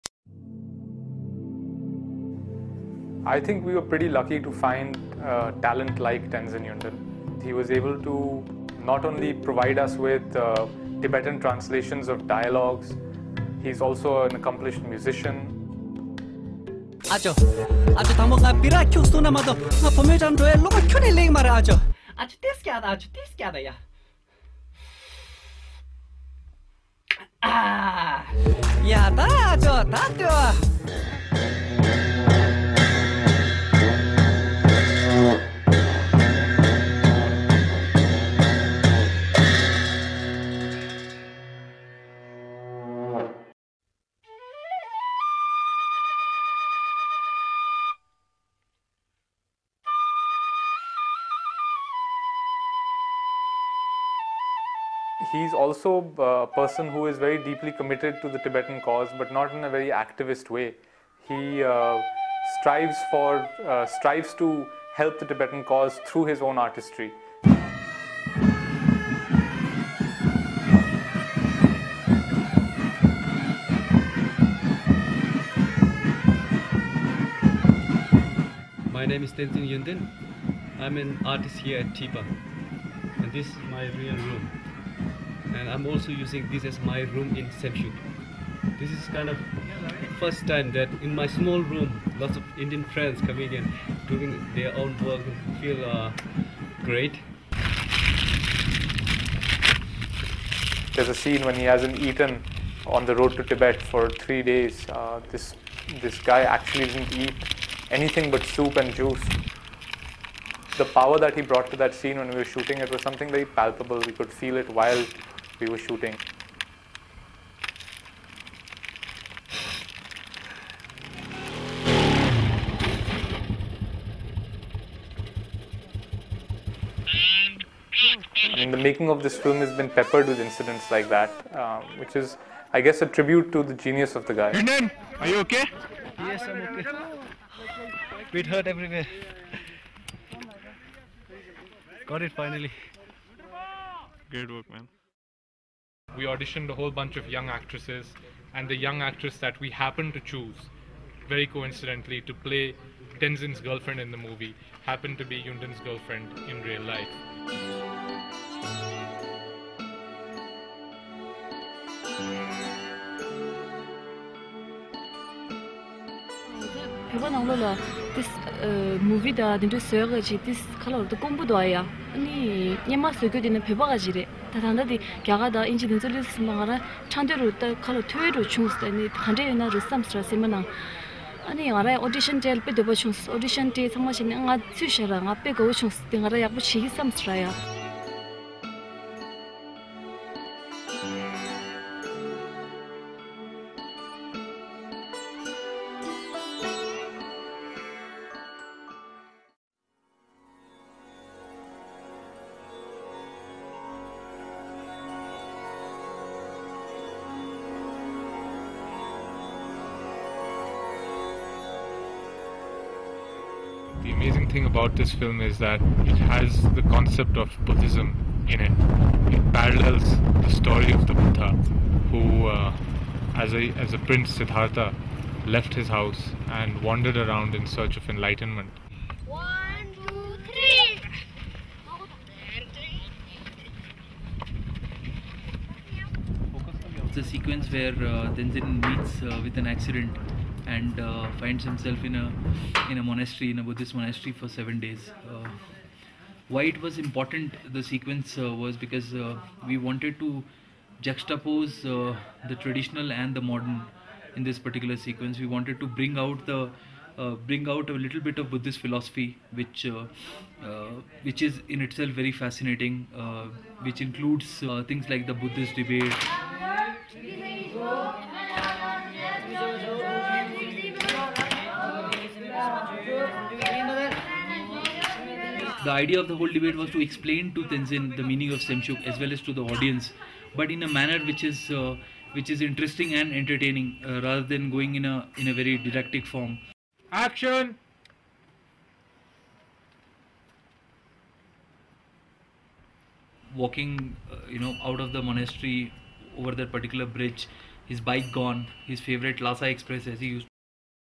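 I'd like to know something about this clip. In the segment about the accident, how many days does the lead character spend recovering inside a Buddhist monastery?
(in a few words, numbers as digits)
7.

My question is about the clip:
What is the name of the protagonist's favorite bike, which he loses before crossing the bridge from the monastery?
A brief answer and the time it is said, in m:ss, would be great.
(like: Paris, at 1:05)
Lhasa Express, at 4:59.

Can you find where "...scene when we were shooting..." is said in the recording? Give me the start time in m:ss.
1:52.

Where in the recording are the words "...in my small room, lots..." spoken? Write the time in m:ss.
1:31.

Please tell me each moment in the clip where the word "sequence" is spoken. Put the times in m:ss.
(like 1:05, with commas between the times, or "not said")
3:57, 4:07, 4:14.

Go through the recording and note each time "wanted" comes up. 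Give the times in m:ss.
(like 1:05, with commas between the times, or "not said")
4:09, 4:15.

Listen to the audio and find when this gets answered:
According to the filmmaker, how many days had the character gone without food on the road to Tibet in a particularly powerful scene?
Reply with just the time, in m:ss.
1:44.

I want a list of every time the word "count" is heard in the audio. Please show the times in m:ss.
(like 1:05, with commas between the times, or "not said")
not said.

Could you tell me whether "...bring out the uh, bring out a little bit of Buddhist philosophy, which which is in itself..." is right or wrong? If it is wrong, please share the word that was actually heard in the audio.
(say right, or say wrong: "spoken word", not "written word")
right.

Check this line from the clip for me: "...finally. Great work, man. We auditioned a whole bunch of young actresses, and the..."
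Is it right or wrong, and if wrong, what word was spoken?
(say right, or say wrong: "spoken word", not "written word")
right.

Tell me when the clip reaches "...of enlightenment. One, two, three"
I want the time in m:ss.
3:47.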